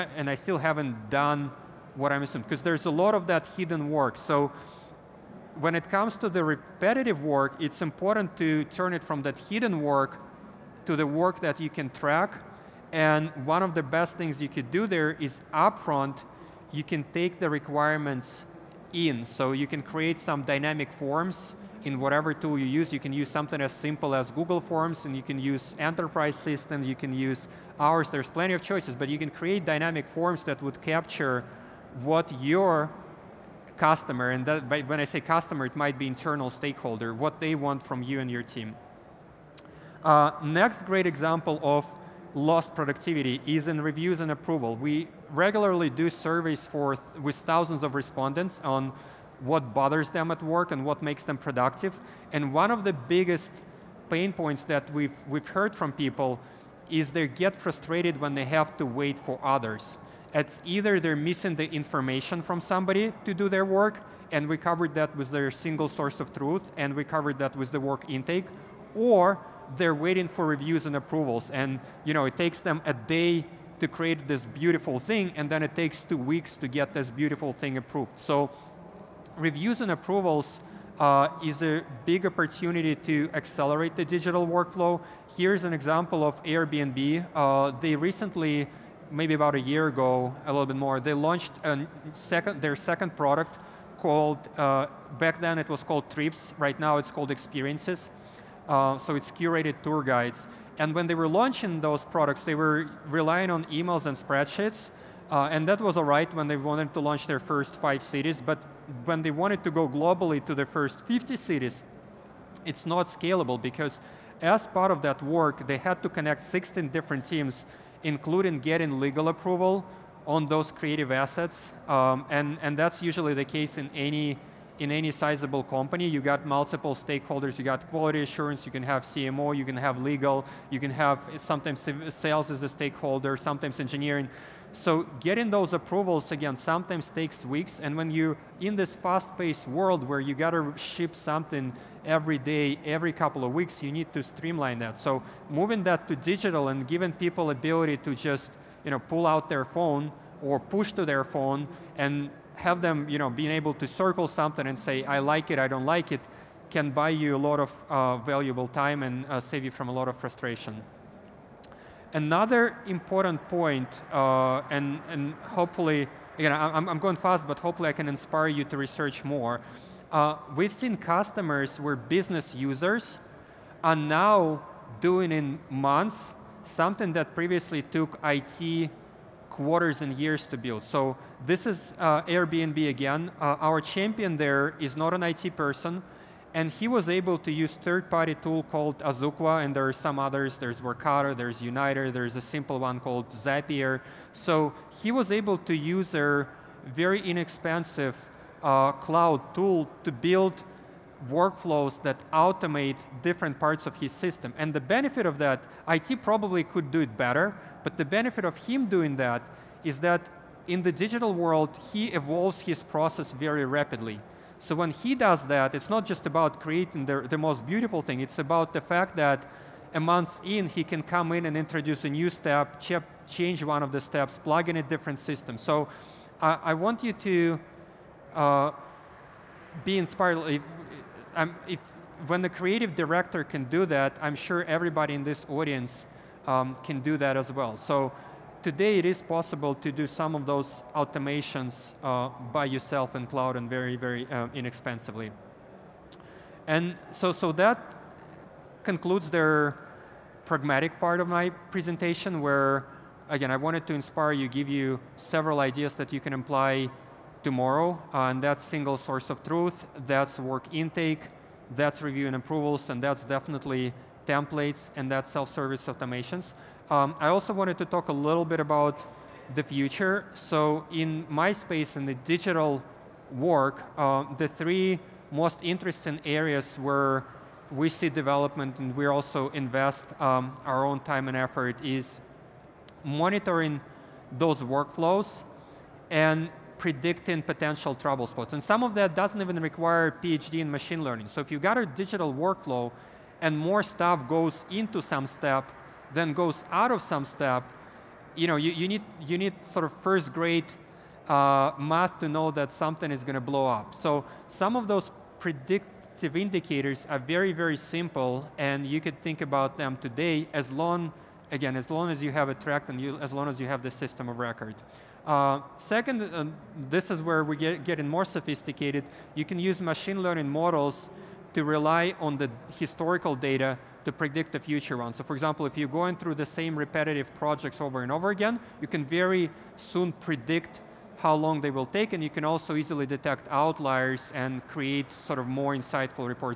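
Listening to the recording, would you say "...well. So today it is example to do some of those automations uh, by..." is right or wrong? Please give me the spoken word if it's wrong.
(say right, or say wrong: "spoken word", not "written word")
wrong: "possible", not "example".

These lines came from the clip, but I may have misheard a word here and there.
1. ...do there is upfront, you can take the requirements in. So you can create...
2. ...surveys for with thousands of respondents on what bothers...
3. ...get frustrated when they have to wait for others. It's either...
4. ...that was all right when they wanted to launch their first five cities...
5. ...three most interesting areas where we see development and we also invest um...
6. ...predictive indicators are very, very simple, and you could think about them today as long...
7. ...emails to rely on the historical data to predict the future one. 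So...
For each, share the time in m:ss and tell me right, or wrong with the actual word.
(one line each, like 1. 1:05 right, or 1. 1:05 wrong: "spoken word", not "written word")
1. 0:14 right
2. 0:46 right
3. 0:57 right
4. 1:45 right
5. 4:34 right
6. 5:05 right
7. 5:20 wrong: "models", not "emails".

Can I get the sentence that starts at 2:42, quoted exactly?
Another important point, uh, and, and hopefully, again, I'm, I'm going fast, but hopefully I can inspire you to research more.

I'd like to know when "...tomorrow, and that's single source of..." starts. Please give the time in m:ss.
4:17.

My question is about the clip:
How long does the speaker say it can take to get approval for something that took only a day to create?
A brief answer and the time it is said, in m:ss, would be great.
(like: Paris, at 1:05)
two weeks, at 1:16.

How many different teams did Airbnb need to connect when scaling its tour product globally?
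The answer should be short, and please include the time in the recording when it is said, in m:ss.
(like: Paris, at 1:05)
16, at 1:56.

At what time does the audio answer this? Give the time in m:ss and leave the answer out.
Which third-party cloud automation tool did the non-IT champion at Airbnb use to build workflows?
3:08.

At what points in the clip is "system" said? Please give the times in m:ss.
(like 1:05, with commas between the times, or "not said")
0:26, 3:24, 3:45, 5:13.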